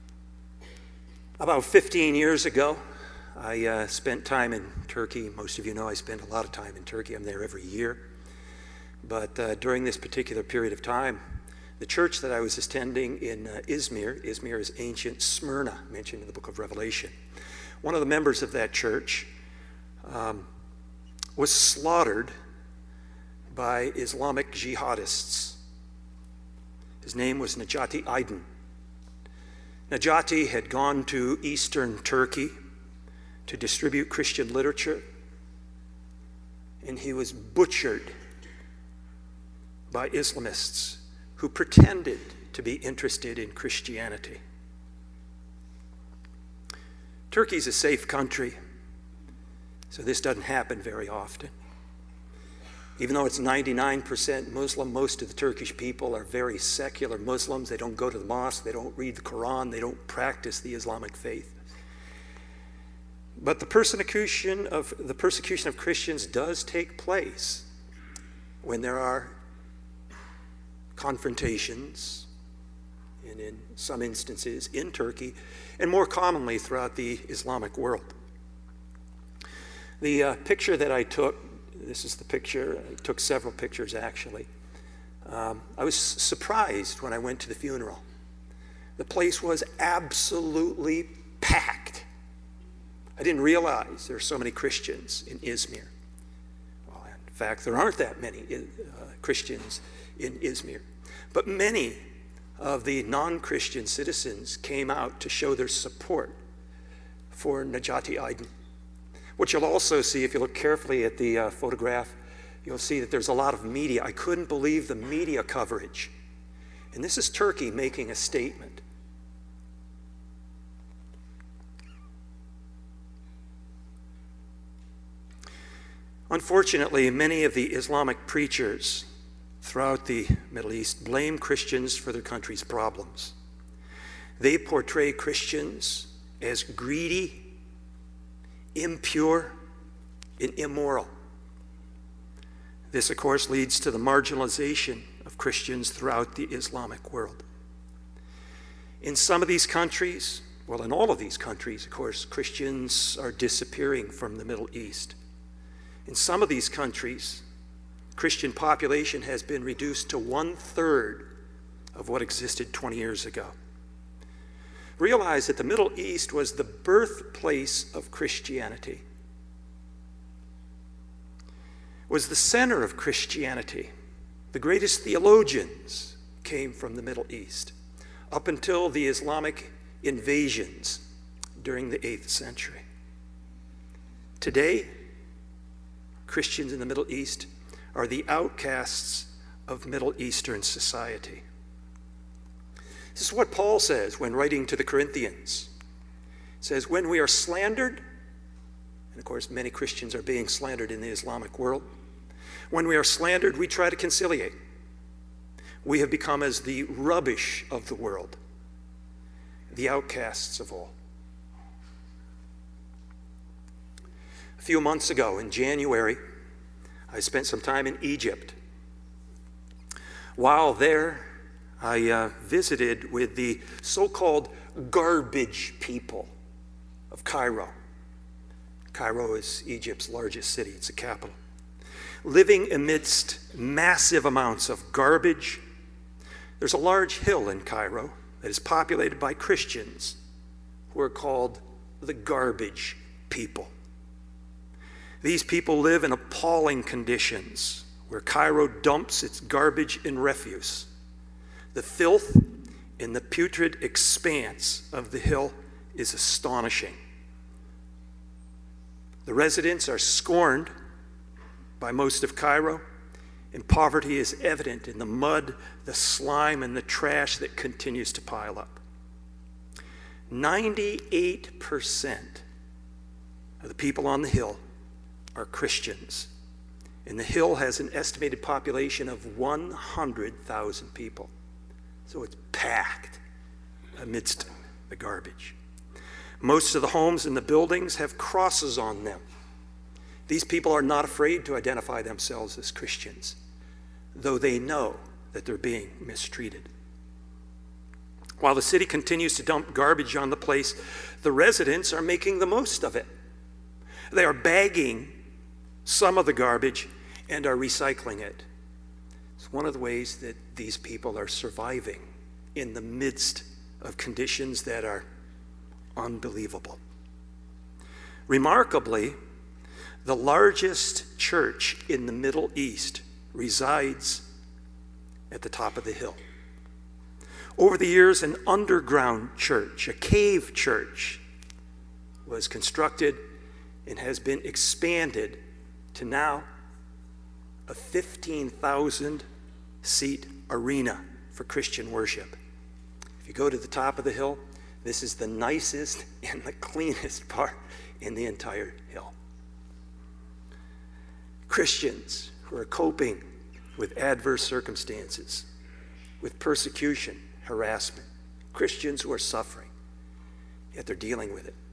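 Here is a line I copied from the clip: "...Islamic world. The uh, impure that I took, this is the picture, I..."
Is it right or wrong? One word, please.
wrong.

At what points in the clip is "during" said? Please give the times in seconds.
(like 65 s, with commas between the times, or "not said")
9 s, 181 s.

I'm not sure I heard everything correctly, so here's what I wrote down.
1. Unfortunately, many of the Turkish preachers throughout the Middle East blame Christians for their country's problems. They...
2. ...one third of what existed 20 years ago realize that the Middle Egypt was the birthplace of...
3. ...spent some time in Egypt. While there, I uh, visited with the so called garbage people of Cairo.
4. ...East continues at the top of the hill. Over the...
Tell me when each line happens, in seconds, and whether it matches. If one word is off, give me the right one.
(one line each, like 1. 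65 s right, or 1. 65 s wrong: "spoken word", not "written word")
1. 126 s wrong: "Islamic", not "Turkish"
2. 160 s wrong: "East", not "Egypt"
3. 217 s right
4. 322 s wrong: "resides", not "continues".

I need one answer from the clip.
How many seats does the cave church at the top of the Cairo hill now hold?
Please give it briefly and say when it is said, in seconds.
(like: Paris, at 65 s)
15,000, at 337 s.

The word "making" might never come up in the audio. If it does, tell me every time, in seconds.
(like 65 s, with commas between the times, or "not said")
117 s, 302 s.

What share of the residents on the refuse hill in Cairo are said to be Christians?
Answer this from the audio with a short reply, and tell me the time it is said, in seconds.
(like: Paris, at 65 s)
98%, at 270 s.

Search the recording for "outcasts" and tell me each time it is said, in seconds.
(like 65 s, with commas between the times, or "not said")
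188 s, 209 s.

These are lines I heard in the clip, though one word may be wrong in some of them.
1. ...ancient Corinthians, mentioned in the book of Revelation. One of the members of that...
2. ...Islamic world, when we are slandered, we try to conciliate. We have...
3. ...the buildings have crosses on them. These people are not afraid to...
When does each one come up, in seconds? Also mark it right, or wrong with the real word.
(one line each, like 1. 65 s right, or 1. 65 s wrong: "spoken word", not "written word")
1. 14 s wrong: "Smyrna", not "Corinthians"
2. 201 s right
3. 287 s right.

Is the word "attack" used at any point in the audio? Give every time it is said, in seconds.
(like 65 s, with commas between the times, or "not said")
not said.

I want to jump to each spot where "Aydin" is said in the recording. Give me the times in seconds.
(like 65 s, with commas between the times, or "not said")
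28 s, 108 s.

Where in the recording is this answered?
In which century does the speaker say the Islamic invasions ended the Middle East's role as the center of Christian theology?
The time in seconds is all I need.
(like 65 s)
181 s.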